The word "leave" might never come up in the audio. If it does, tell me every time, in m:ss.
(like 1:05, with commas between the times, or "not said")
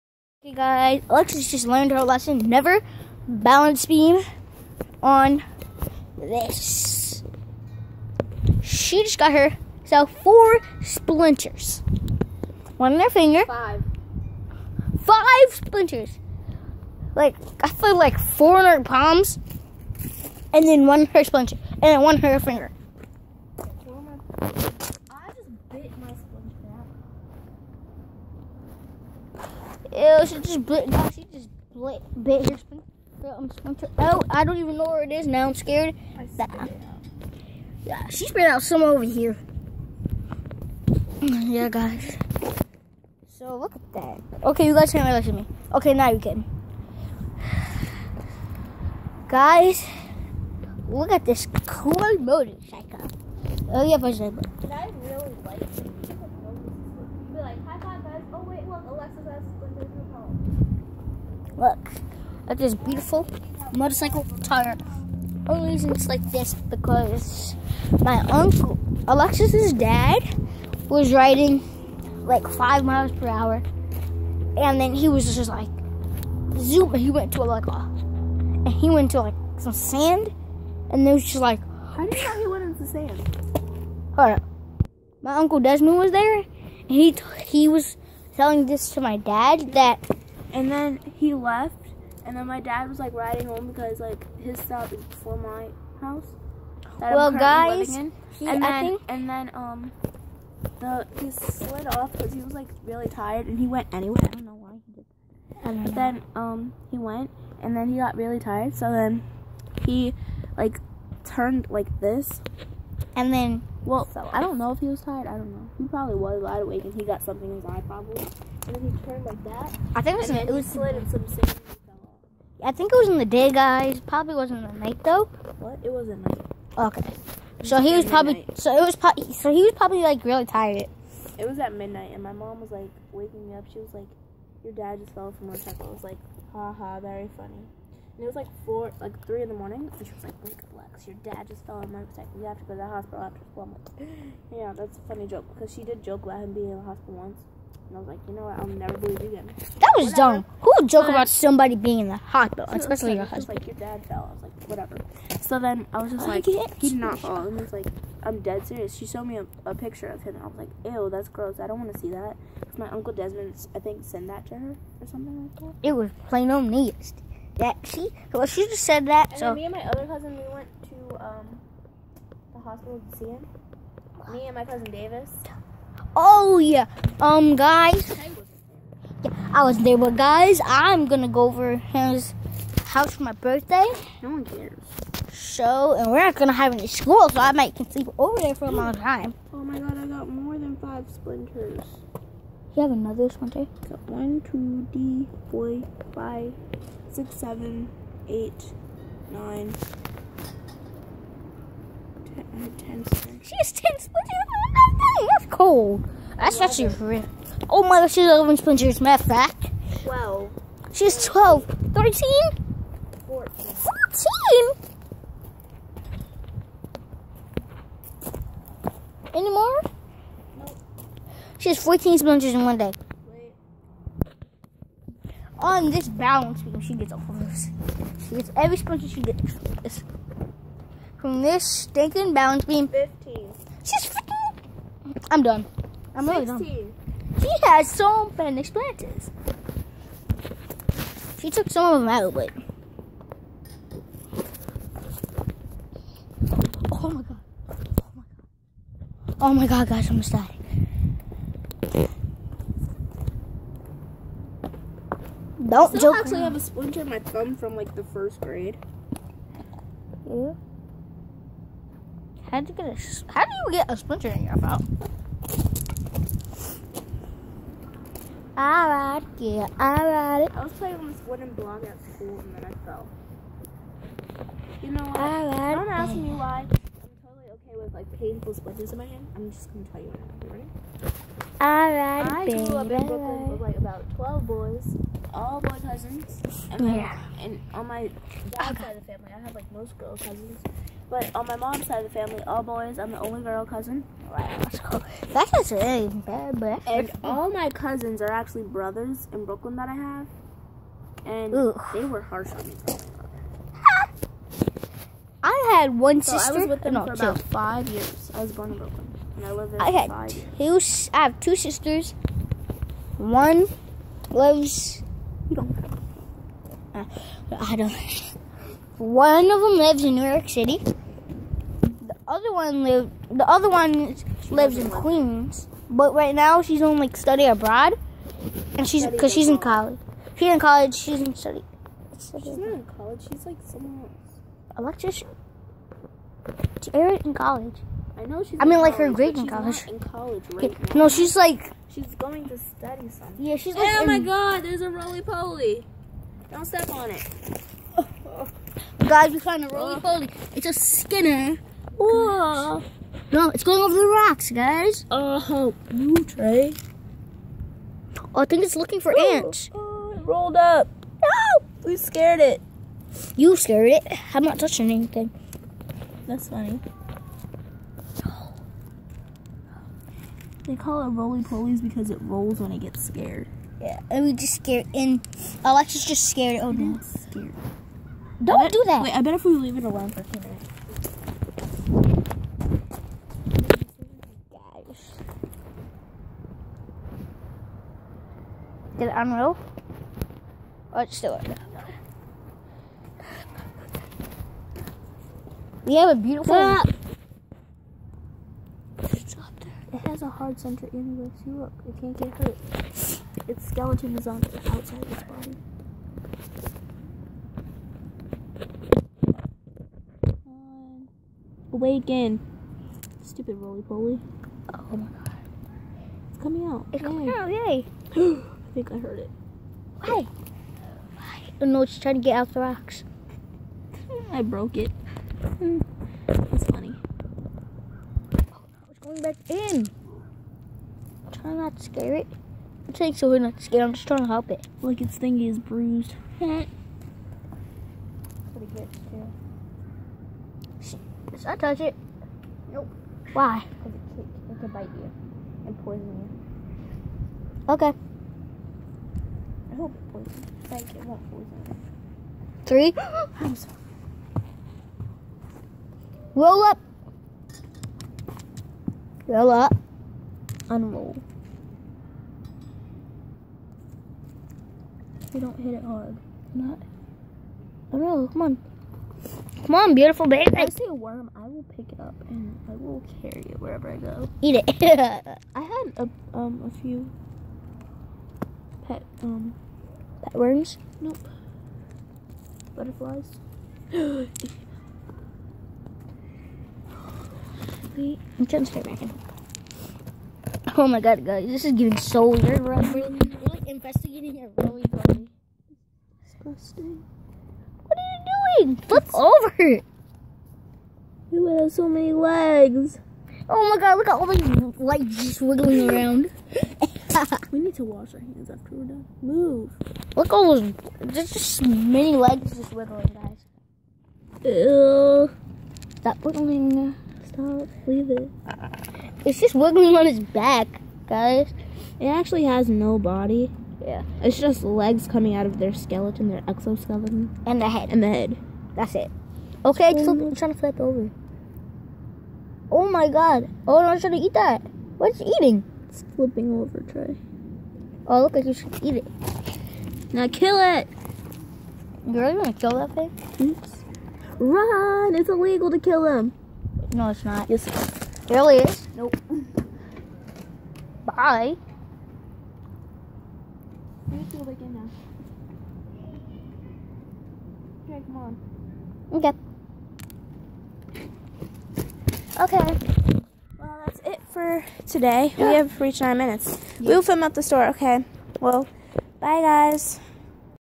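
6:19, 8:37.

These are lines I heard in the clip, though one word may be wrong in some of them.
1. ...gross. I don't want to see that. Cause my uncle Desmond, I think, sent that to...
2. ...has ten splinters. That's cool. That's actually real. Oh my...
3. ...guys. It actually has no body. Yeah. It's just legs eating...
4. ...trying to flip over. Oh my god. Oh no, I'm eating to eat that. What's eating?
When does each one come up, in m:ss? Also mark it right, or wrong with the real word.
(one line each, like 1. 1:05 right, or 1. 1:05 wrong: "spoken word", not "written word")
1. 2:41 right
2. 3:23 right
3. 8:41 wrong: "coming", not "eating"
4. 8:50 wrong: "trying", not "eating".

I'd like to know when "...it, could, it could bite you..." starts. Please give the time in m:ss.
7:23.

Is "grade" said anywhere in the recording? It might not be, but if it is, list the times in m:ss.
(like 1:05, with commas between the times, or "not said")
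4:18, 5:39.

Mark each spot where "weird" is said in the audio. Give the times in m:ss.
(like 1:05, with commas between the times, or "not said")
8:12.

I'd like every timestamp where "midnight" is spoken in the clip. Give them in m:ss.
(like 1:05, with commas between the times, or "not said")
2:11.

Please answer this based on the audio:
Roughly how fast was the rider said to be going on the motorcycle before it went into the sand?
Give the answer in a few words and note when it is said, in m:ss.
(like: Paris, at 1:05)
5 miles per hour, at 1:12.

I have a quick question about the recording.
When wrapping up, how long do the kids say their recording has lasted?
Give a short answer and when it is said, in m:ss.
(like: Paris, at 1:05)
9 minutes, at 9:26.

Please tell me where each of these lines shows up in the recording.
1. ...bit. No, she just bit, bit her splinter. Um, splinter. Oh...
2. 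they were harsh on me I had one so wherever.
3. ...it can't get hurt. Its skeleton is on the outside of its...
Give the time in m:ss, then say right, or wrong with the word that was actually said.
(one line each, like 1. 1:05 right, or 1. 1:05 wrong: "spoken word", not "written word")
1. 0:30 right
2. 5:01 wrong: "sister", not "wherever"
3. 6:41 right.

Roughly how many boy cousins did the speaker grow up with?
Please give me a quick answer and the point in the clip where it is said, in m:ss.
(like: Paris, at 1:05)
12, at 4:43.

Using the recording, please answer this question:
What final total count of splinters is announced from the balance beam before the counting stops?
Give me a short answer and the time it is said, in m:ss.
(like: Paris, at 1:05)
16, at 3:56.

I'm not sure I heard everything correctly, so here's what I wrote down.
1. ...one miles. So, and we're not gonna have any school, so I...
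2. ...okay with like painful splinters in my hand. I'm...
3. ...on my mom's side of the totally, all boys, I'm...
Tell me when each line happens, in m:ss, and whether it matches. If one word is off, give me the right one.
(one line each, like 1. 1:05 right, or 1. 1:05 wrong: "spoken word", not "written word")
1. 3:04 wrong: "cares", not "miles"
2. 4:37 right
3. 4:51 wrong: "family", not "totally".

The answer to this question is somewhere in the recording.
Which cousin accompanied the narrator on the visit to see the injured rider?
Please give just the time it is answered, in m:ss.
2:54.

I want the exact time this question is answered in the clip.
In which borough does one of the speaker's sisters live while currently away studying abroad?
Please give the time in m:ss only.
5:24.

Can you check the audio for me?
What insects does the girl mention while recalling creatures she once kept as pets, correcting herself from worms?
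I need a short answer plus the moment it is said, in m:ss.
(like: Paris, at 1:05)
Butterflies, at 8:02.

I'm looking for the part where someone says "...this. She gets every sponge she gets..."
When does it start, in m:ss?
3:47.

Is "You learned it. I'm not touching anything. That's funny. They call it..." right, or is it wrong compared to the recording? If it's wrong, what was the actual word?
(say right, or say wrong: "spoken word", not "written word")
wrong: "scared", not "learned".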